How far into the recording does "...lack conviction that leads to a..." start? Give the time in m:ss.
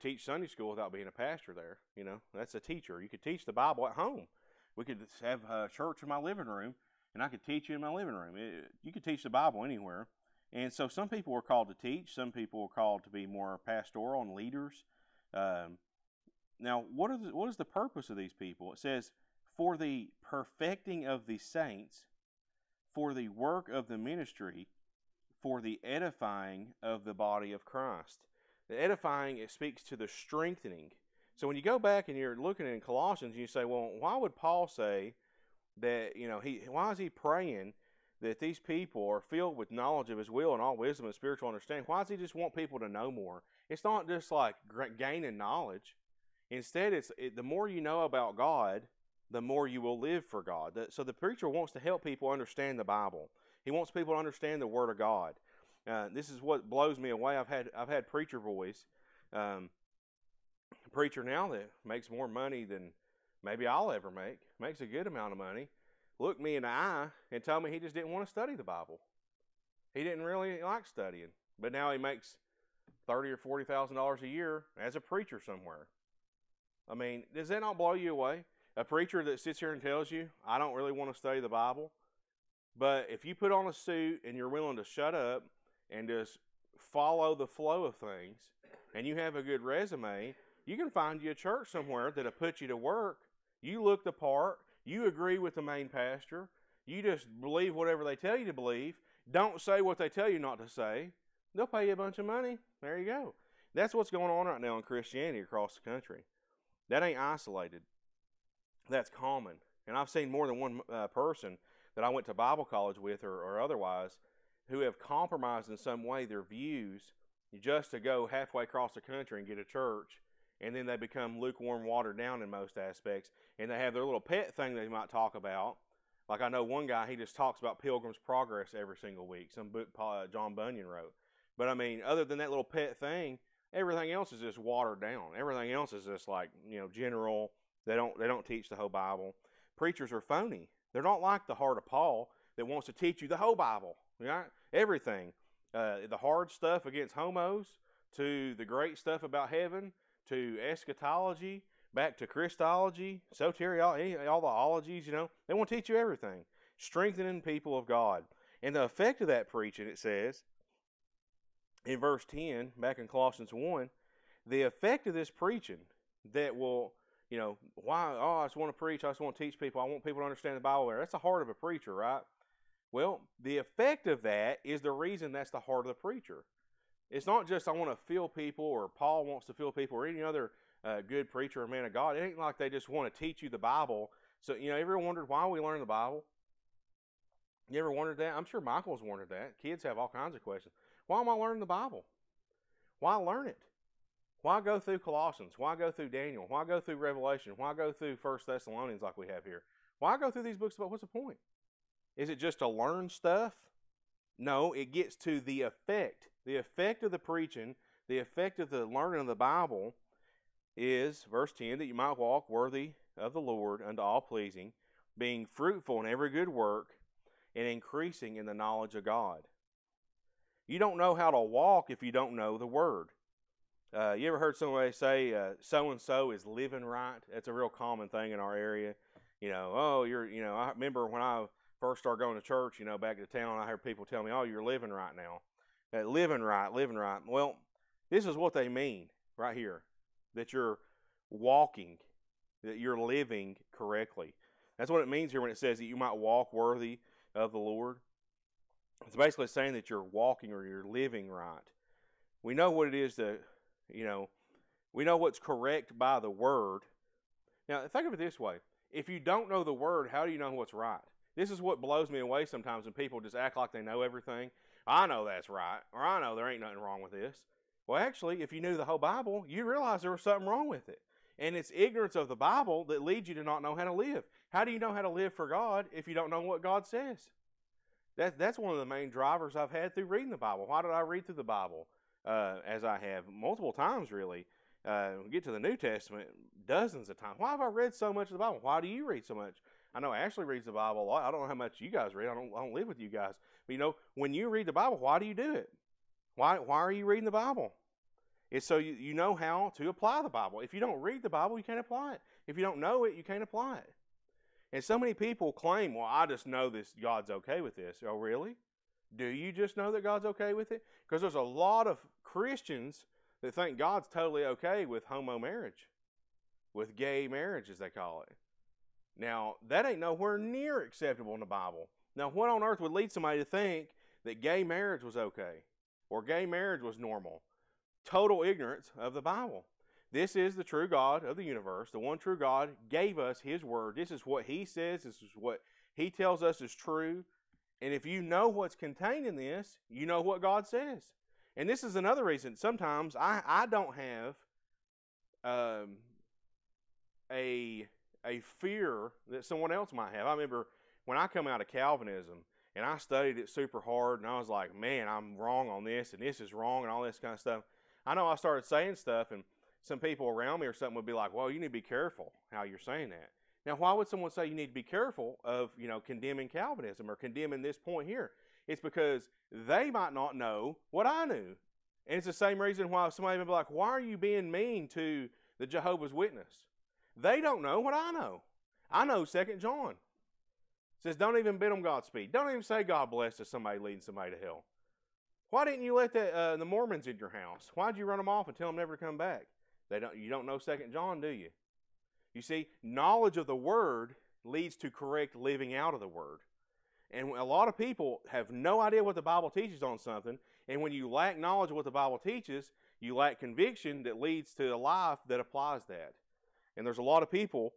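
6:43.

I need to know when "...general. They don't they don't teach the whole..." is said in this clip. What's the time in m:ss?
2:16.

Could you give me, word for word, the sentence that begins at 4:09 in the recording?
It's basically saying that you're walking or you're living right.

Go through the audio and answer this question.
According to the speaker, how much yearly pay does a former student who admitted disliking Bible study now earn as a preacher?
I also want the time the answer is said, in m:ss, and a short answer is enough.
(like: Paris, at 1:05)
$30,000 or $40,000, at 1:13.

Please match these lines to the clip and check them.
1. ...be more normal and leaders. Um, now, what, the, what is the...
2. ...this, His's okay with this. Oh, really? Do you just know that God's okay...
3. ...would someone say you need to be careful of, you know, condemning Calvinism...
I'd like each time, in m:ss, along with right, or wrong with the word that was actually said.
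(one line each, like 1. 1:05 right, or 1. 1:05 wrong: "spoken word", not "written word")
1. 0:13 wrong: "pastoral", not "normal"
2. 5:06 wrong: "God", not "His"
3. 6:03 right.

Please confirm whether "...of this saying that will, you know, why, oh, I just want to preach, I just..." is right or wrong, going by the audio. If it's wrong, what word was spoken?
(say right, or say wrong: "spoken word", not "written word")
wrong: "preaching", not "saying".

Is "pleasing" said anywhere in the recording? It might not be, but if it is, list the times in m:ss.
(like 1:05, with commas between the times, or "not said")
3:34.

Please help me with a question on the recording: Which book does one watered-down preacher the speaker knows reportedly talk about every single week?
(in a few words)
Pilgrim's Progress.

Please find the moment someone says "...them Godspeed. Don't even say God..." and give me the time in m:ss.
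6:21.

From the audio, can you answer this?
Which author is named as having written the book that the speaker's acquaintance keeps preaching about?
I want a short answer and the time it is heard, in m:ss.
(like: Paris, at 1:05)
John Bunyan, at 2:10.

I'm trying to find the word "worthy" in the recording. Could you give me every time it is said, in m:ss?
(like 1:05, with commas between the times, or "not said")
3:32, 4:06.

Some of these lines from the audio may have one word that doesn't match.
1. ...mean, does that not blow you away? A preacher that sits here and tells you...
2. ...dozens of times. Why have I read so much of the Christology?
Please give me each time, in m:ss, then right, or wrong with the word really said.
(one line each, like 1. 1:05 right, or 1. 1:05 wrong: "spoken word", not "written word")
1. 1:16 right
2. 4:46 wrong: "Bible", not "Christology".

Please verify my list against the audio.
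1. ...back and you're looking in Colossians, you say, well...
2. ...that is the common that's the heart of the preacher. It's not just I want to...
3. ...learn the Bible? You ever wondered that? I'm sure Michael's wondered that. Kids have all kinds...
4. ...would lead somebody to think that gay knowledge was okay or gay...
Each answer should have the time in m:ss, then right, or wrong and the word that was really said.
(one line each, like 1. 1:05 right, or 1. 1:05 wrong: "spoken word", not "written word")
1. 0:31 right
2. 2:54 wrong: "reason", not "common"
3. 3:05 right
4. 5:22 wrong: "marriage", not "knowledge".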